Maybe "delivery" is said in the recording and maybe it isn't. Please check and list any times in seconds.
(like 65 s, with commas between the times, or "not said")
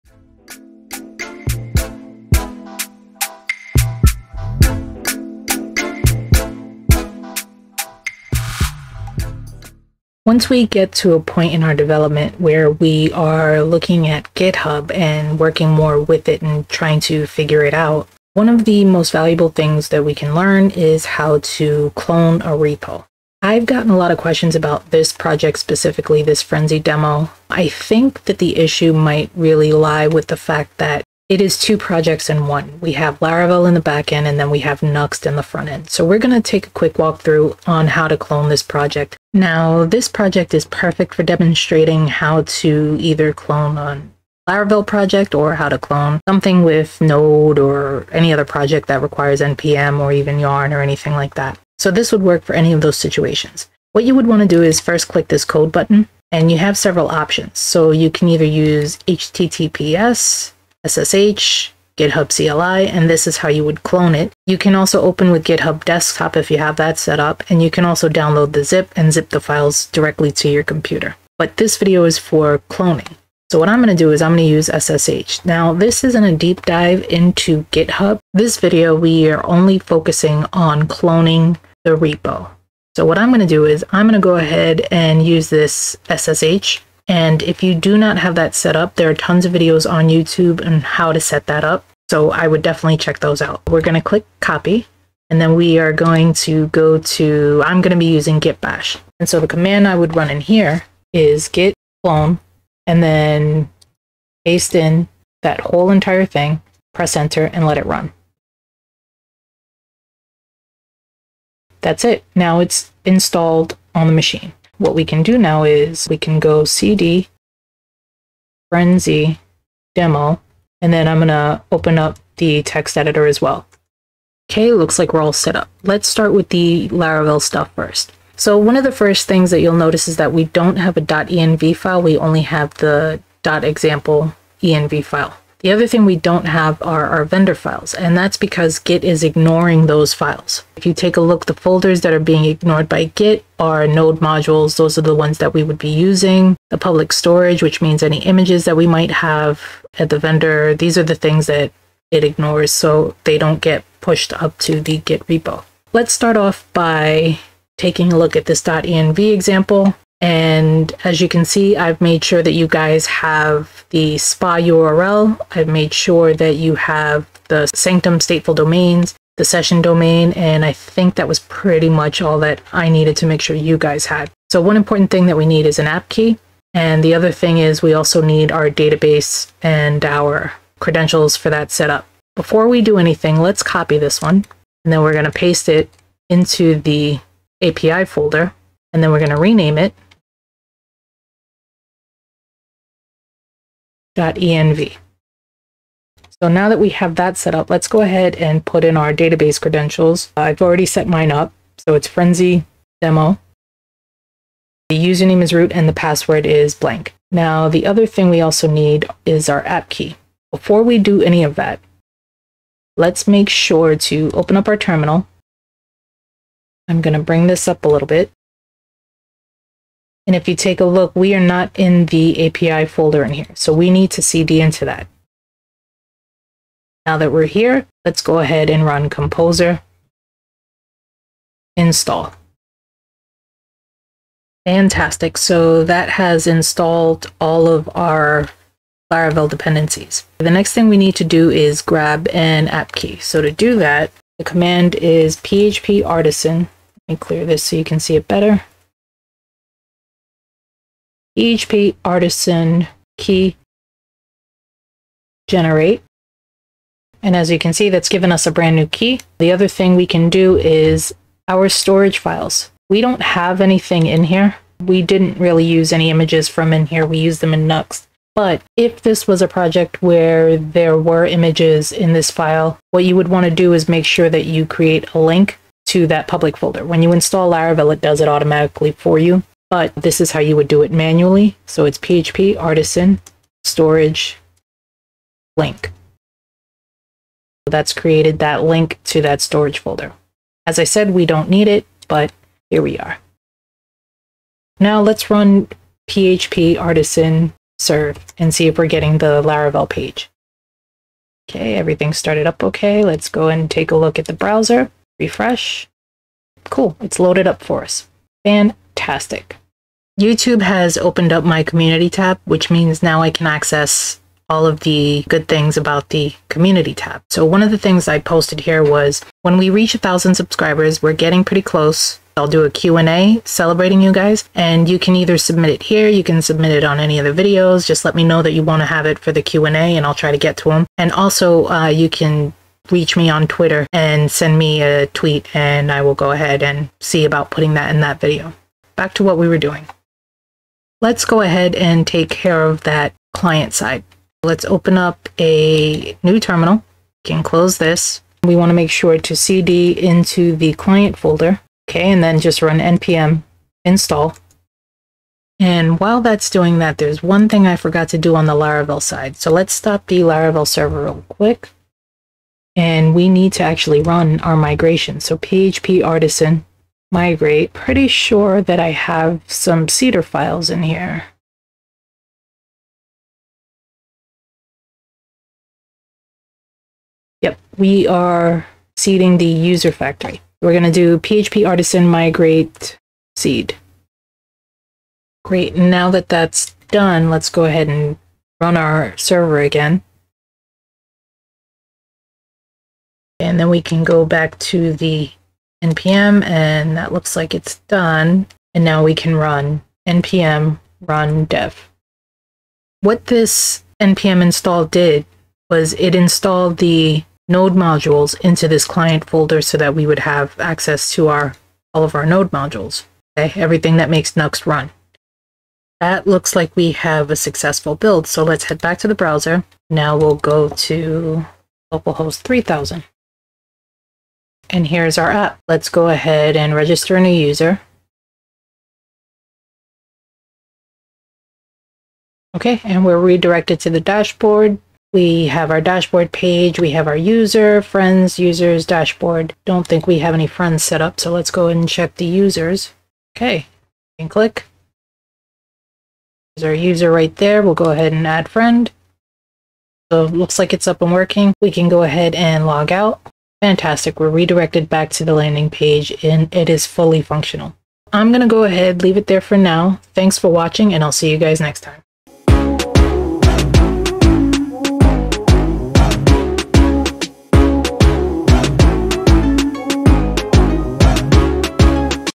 not said.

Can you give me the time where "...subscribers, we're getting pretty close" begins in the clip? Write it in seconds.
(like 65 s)
320 s.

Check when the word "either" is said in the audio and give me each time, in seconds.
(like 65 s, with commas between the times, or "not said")
42 s, 58 s, 325 s.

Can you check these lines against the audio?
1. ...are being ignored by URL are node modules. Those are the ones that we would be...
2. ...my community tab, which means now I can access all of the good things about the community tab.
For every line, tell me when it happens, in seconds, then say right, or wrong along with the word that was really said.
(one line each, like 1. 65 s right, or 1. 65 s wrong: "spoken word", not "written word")
1. 142 s wrong: "Git", not "URL"
2. 311 s right.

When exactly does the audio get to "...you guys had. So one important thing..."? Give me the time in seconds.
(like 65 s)
173 s.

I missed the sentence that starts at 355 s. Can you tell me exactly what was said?
And while that's doing that, there's one thing I forgot to do on the Laravel side.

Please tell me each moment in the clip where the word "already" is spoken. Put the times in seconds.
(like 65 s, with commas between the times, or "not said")
200 s.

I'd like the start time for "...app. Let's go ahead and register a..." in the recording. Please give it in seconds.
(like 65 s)
425 s.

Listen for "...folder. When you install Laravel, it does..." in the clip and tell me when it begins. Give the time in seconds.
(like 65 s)
276 s.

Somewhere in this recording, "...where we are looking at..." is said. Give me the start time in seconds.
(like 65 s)
12 s.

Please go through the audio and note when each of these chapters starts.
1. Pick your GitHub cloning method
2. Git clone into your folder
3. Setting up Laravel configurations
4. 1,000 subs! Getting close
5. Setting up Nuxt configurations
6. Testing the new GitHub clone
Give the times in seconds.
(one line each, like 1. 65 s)
1. 55 s
2. 95 s
3. 127 s
4. 308 s
5. 340 s
6. 420 s.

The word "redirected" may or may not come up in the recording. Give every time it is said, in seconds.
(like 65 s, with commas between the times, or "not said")
433 s, 454 s.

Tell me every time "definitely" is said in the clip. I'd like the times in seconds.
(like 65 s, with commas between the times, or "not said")
92 s.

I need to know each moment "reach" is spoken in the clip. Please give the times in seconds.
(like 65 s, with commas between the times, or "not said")
319 s, 332 s.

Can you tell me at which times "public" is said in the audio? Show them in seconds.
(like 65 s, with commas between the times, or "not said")
146 s, 276 s.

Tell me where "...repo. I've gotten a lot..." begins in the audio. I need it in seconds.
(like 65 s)
22 s.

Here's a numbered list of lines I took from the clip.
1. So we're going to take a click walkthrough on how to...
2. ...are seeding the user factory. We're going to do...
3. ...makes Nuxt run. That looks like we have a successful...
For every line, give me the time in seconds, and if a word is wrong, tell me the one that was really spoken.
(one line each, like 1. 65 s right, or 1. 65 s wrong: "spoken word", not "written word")
1. 35 s wrong: "quick", not "click"
2. 378 s right
3. 414 s right.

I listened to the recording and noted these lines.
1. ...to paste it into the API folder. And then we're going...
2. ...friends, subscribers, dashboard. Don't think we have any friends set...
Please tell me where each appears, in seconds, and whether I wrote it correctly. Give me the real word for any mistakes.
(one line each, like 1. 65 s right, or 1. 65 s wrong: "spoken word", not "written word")
1. 185 s right
2. 437 s wrong: "users", not "subscribers".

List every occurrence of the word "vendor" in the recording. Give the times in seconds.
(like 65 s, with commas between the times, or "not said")
137 s, 150 s.